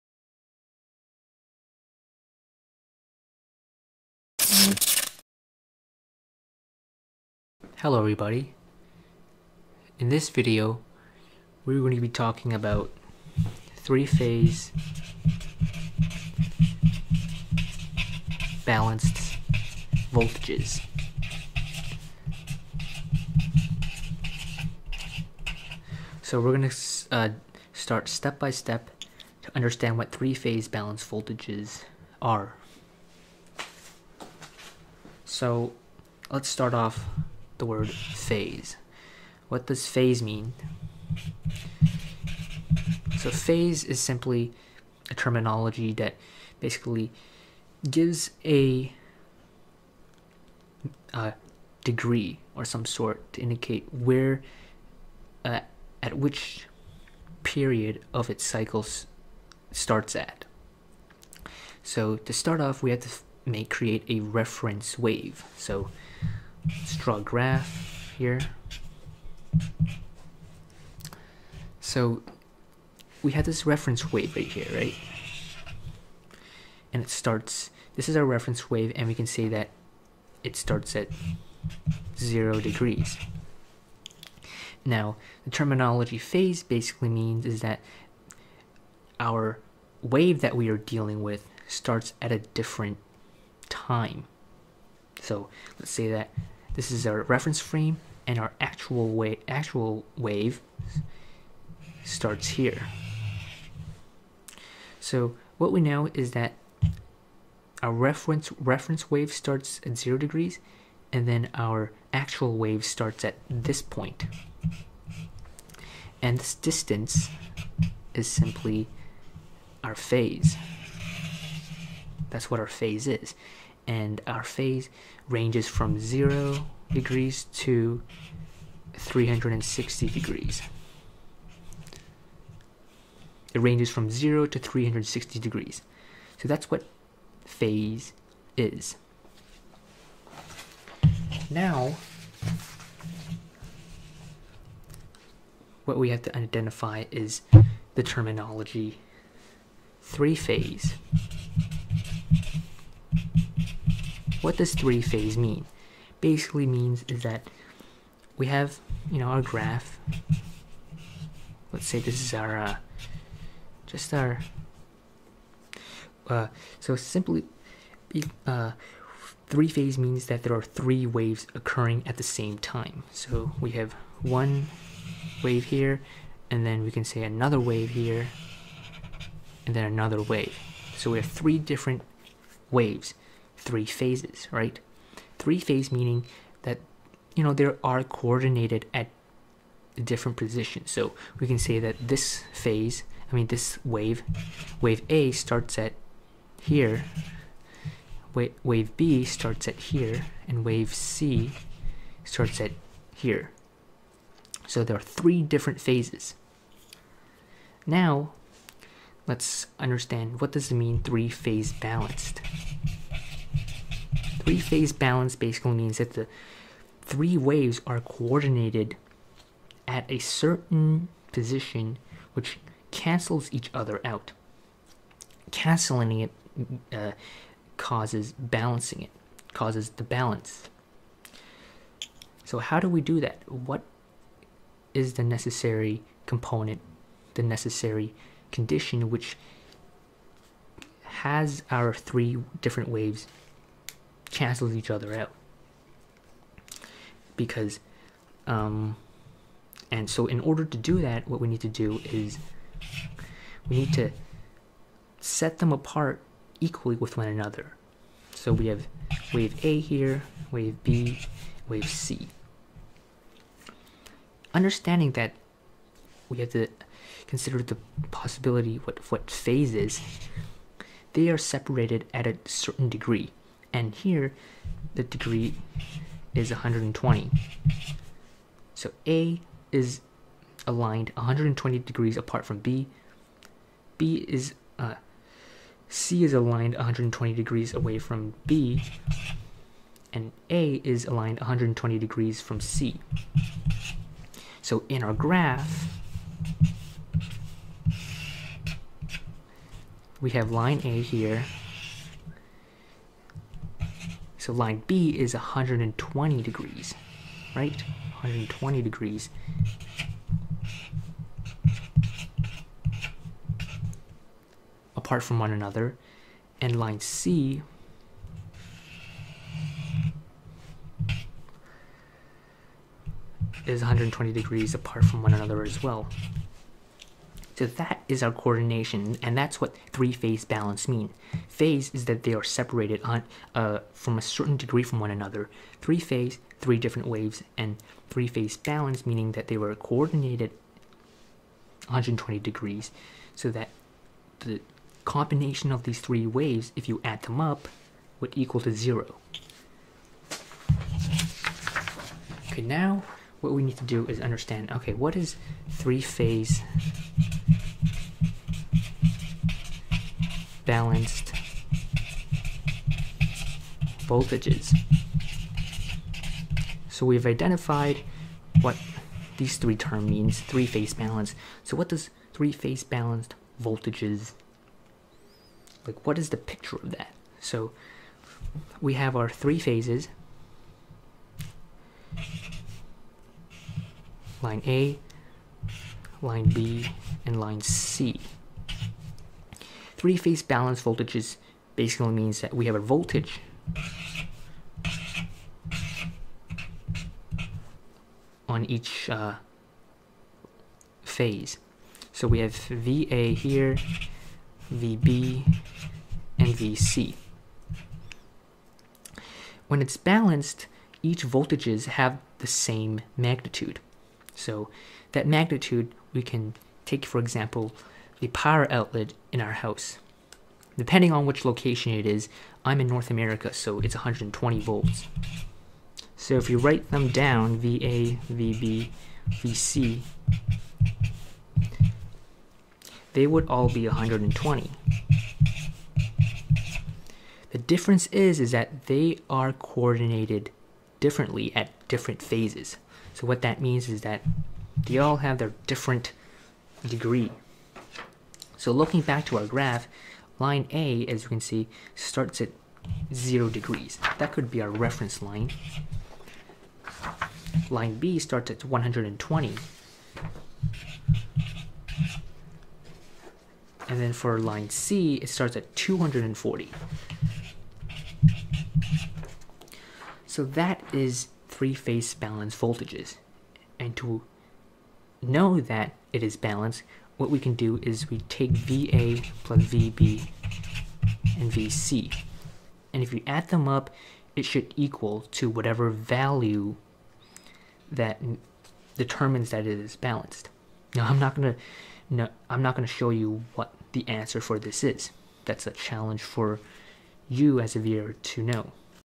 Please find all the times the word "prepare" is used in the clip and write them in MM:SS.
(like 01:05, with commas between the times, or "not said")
not said.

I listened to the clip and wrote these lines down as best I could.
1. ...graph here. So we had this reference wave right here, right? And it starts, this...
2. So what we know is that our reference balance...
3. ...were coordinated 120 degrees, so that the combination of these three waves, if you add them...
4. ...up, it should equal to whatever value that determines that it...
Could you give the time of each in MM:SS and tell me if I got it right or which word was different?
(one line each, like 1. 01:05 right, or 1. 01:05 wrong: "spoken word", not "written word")
1. 01:07 right
2. 01:45 wrong: "reference", not "balance"
3. 05:39 right
4. 08:03 right.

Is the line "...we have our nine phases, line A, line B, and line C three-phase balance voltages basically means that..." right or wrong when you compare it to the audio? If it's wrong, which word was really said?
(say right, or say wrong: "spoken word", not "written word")
wrong: "three", not "nine".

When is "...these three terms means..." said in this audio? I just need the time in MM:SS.
06:09.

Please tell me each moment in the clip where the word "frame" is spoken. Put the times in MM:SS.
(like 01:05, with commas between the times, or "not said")
01:37.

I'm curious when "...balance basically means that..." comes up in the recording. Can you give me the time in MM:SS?
03:34.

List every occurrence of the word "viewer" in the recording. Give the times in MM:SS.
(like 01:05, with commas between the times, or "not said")
08:17.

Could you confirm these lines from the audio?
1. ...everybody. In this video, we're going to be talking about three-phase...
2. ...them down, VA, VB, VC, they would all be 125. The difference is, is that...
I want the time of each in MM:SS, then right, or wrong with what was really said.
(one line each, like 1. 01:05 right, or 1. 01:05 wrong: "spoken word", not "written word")
1. 00:07 right
2. 07:06 wrong: "120", not "125".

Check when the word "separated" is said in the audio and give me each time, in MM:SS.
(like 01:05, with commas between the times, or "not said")
04:31, 05:32.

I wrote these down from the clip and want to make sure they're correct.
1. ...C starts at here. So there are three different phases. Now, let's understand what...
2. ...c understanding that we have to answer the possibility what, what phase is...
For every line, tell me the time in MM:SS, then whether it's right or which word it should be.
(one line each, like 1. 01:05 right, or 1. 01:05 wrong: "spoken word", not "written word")
1. 03:20 right
2. 04:21 wrong: "consider", not "answer".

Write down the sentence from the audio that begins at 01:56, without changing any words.
And this distance is simply our phase.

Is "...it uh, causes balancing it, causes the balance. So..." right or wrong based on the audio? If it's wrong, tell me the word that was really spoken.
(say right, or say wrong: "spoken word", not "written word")
right.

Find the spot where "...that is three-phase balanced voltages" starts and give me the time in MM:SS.
07:50.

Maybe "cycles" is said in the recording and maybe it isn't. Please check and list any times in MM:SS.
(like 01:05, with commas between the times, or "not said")
00:58.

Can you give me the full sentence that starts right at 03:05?
Three phase meaning that you know there are coordinated at different positions.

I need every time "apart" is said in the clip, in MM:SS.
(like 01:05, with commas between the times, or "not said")
04:15, 04:42, 05:14, 05:24.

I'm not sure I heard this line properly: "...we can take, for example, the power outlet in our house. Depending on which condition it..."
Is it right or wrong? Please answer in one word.
wrong.